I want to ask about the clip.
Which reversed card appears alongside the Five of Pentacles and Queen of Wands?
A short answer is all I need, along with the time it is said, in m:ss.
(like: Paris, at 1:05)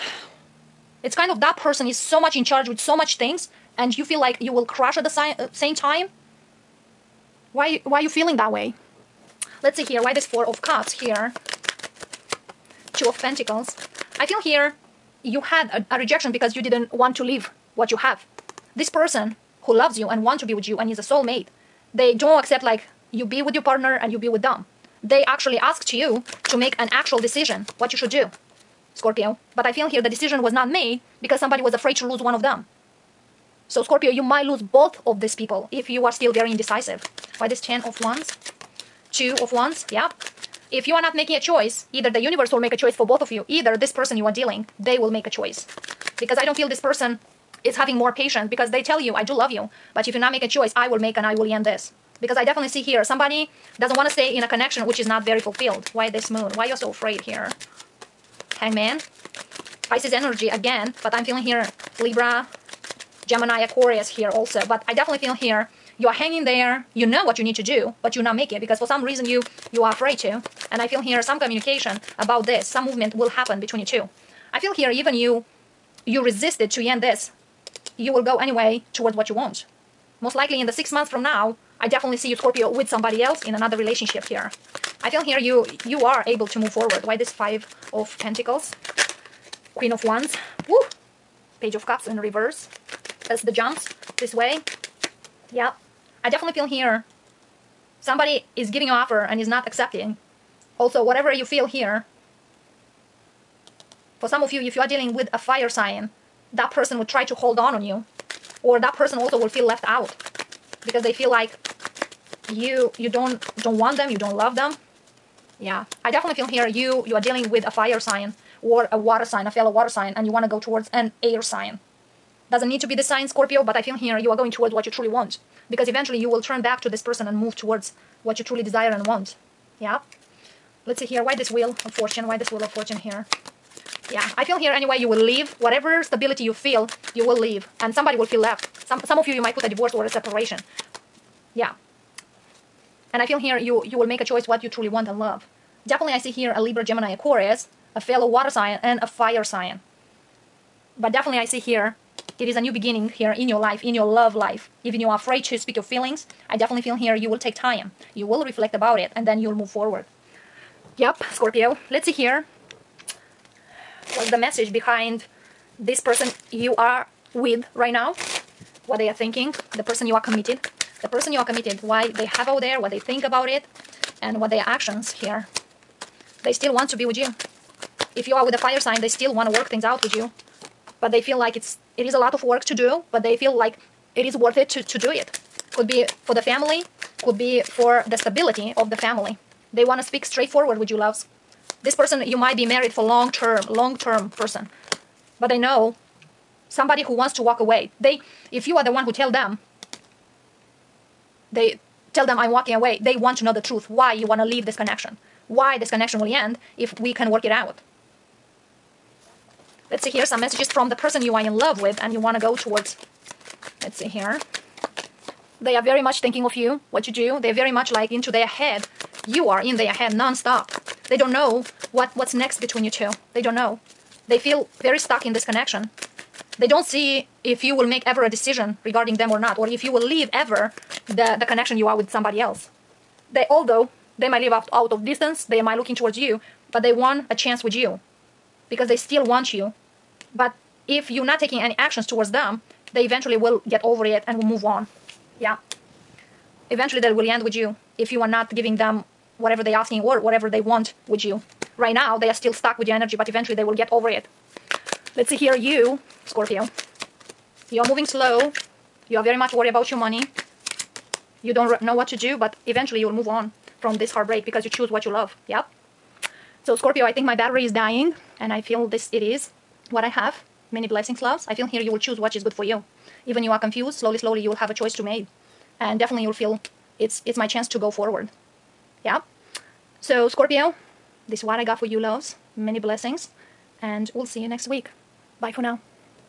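Page of Cups, at 1:31.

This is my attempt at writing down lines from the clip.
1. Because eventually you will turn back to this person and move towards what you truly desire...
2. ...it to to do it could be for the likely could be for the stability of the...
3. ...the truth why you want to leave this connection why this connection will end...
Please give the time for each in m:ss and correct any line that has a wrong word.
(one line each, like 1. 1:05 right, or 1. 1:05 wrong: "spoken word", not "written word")
1. 2:05 right
2. 3:04 wrong: "family", not "likely"
3. 3:23 right.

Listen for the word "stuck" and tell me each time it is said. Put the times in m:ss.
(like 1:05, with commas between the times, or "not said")
3:44, 4:12.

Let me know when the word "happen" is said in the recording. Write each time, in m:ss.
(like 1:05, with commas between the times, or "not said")
1:13.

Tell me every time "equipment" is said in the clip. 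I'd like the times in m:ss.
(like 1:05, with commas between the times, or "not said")
not said.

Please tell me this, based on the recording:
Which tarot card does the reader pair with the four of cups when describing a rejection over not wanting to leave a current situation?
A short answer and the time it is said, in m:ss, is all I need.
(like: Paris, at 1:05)
Two of pentacles, at 0:12.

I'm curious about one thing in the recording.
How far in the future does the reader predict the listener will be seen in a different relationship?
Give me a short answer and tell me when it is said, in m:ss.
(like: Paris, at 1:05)
6 months, at 1:20.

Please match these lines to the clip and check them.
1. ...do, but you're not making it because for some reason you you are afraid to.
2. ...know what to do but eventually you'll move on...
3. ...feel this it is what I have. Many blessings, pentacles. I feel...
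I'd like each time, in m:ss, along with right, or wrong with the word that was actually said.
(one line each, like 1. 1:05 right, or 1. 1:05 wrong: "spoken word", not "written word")
1. 1:07 right
2. 4:21 right
3. 4:28 wrong: "loves", not "pentacles".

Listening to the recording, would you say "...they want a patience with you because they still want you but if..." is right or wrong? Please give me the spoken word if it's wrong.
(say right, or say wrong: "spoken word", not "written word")
wrong: "chance", not "patience".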